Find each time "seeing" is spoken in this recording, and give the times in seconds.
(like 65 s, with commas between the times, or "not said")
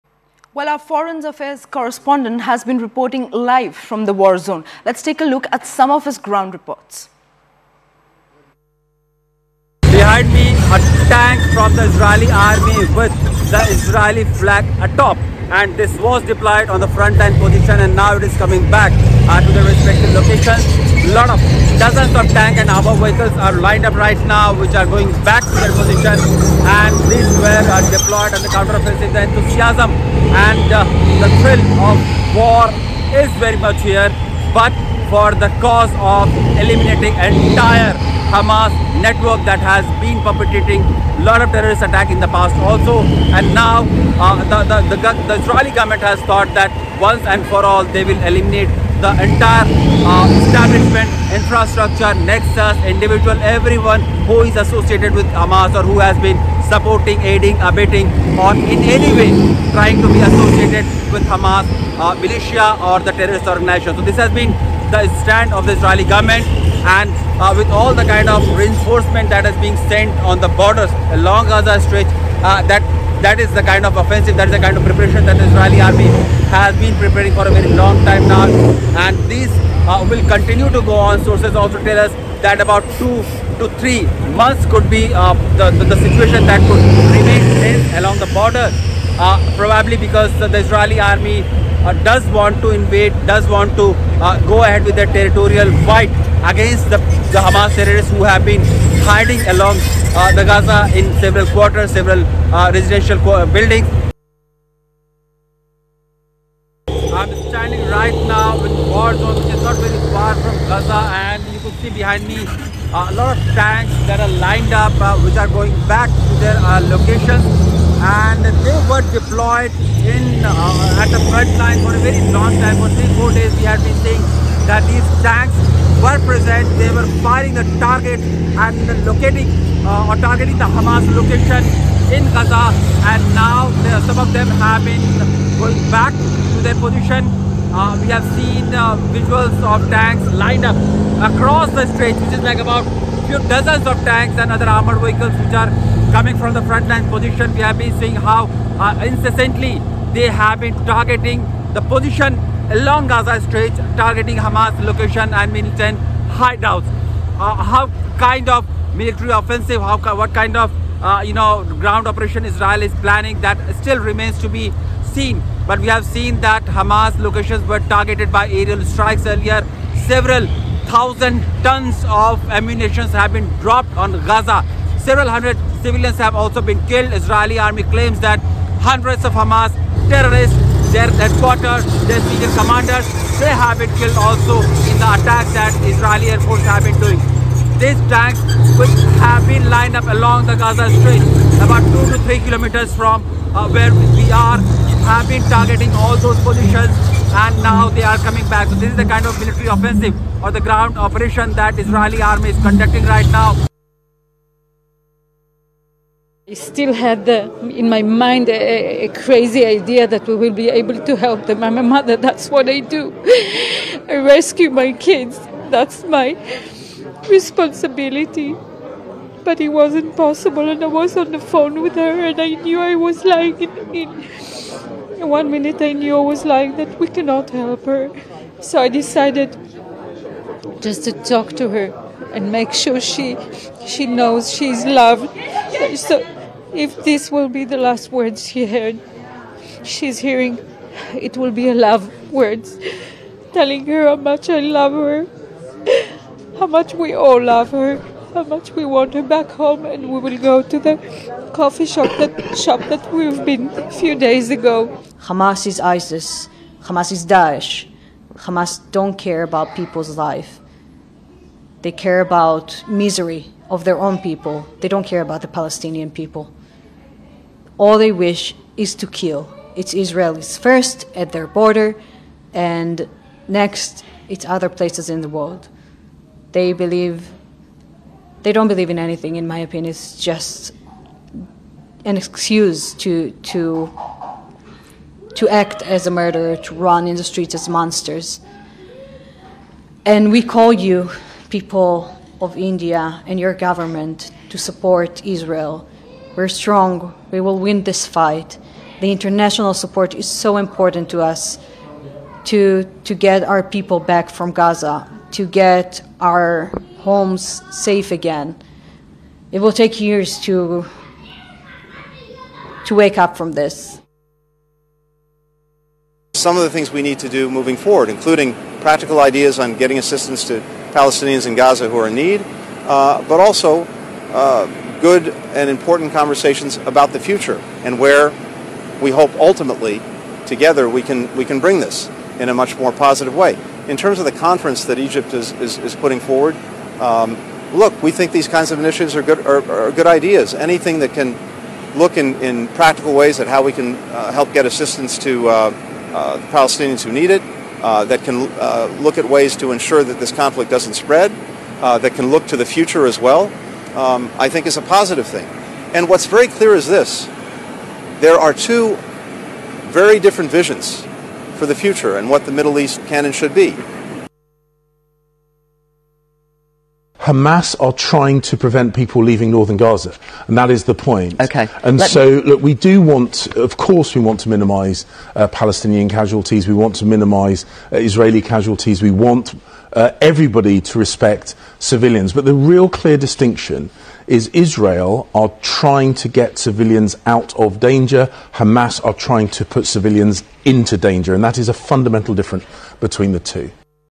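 124 s, 147 s.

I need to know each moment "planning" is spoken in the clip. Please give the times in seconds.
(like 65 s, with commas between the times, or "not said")
163 s.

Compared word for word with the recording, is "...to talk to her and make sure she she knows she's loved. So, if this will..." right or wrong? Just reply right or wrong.
right.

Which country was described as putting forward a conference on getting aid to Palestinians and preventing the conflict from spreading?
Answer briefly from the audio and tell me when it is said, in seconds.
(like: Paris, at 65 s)
Egypt, at 334 s.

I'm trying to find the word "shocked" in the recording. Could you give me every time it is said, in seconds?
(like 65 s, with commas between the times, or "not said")
not said.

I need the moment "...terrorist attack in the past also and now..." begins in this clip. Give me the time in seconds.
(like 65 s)
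41 s.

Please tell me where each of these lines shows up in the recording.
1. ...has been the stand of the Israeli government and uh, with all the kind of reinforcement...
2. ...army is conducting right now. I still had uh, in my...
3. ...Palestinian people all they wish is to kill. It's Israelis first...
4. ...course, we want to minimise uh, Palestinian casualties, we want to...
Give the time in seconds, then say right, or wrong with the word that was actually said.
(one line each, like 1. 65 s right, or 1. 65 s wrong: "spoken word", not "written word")
1. 64 s right
2. 202 s right
3. 265 s right
4. 373 s right.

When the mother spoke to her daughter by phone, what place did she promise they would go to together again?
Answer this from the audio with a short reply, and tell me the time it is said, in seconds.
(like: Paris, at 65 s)
The coffee shop, at 251 s.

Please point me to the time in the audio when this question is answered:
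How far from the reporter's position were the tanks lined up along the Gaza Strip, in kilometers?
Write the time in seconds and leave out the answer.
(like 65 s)
192 s.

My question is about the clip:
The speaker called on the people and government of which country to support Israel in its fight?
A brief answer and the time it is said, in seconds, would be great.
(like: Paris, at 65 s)
India, at 292 s.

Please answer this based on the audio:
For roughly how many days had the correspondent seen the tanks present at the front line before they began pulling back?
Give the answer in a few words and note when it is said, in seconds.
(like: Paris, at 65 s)
3 or 4 days, at 122 s.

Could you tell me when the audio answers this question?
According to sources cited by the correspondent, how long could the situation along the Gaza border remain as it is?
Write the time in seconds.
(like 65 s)
82 s.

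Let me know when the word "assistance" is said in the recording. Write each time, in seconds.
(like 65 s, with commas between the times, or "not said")
319 s, 344 s.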